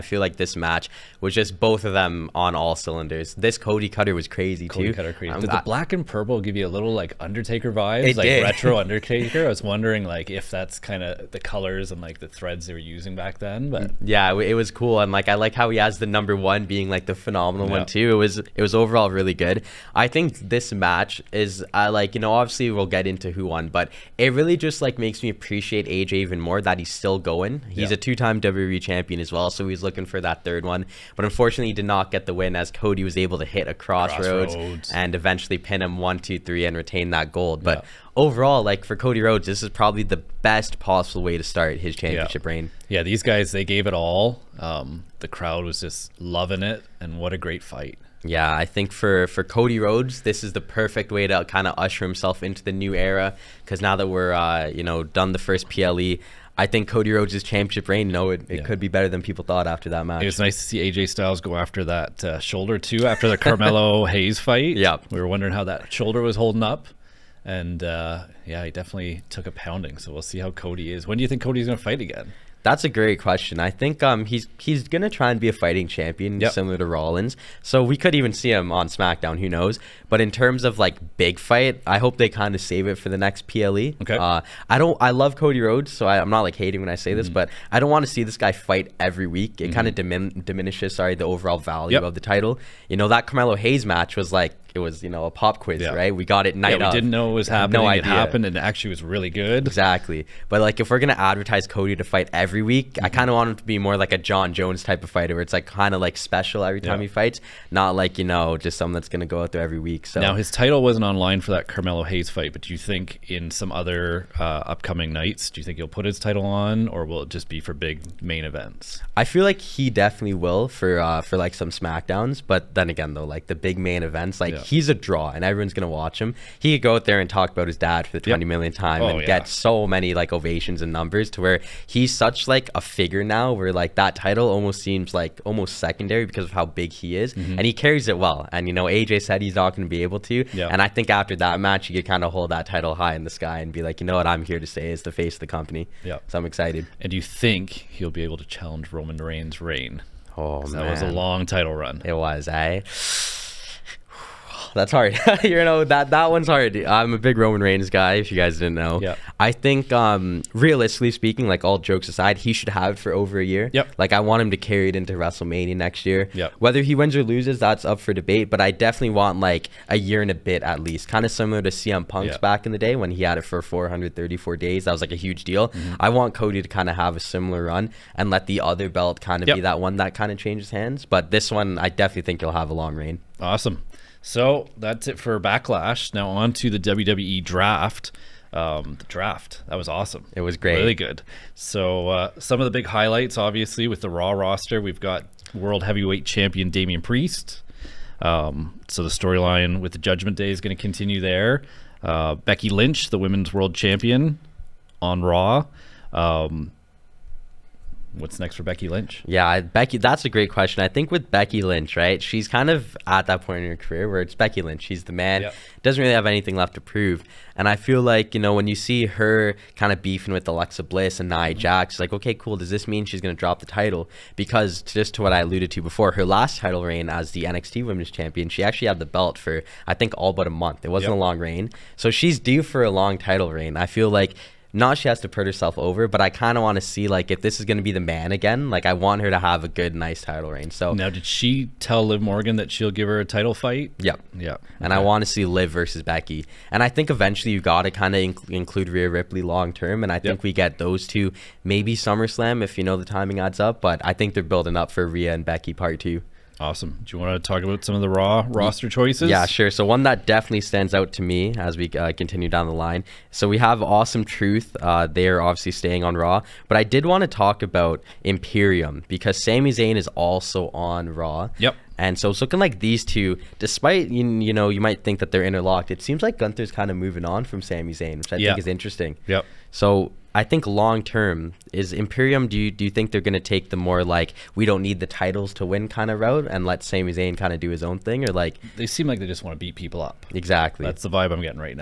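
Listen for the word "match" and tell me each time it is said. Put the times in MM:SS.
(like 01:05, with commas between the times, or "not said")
00:00, 00:20, 01:00, 01:33, 02:21.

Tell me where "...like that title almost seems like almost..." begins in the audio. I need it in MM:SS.
02:13.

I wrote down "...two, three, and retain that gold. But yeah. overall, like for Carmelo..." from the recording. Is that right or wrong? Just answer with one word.
wrong.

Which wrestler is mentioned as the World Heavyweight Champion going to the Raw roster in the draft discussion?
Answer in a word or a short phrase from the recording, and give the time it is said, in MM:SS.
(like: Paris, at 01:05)
Damian Priest, at 03:16.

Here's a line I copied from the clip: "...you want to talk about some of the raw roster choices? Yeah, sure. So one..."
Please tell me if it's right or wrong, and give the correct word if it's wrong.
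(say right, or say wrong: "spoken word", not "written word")
right.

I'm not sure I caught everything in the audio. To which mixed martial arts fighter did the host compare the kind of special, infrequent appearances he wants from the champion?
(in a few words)
Jon Jones.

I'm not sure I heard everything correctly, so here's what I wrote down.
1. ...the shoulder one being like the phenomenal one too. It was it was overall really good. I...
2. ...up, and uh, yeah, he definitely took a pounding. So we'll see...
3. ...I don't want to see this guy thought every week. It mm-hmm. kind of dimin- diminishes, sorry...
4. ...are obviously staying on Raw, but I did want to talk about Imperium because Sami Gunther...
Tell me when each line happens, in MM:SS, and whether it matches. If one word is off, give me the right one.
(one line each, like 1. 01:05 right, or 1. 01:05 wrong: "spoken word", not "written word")
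1. 00:15 wrong: "number", not "shoulder"
2. 01:06 right
3. 01:27 wrong: "fight", not "thought"
4. 04:25 wrong: "Zayn", not "Gunther".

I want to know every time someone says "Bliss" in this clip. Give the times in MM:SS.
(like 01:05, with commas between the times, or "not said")
03:40.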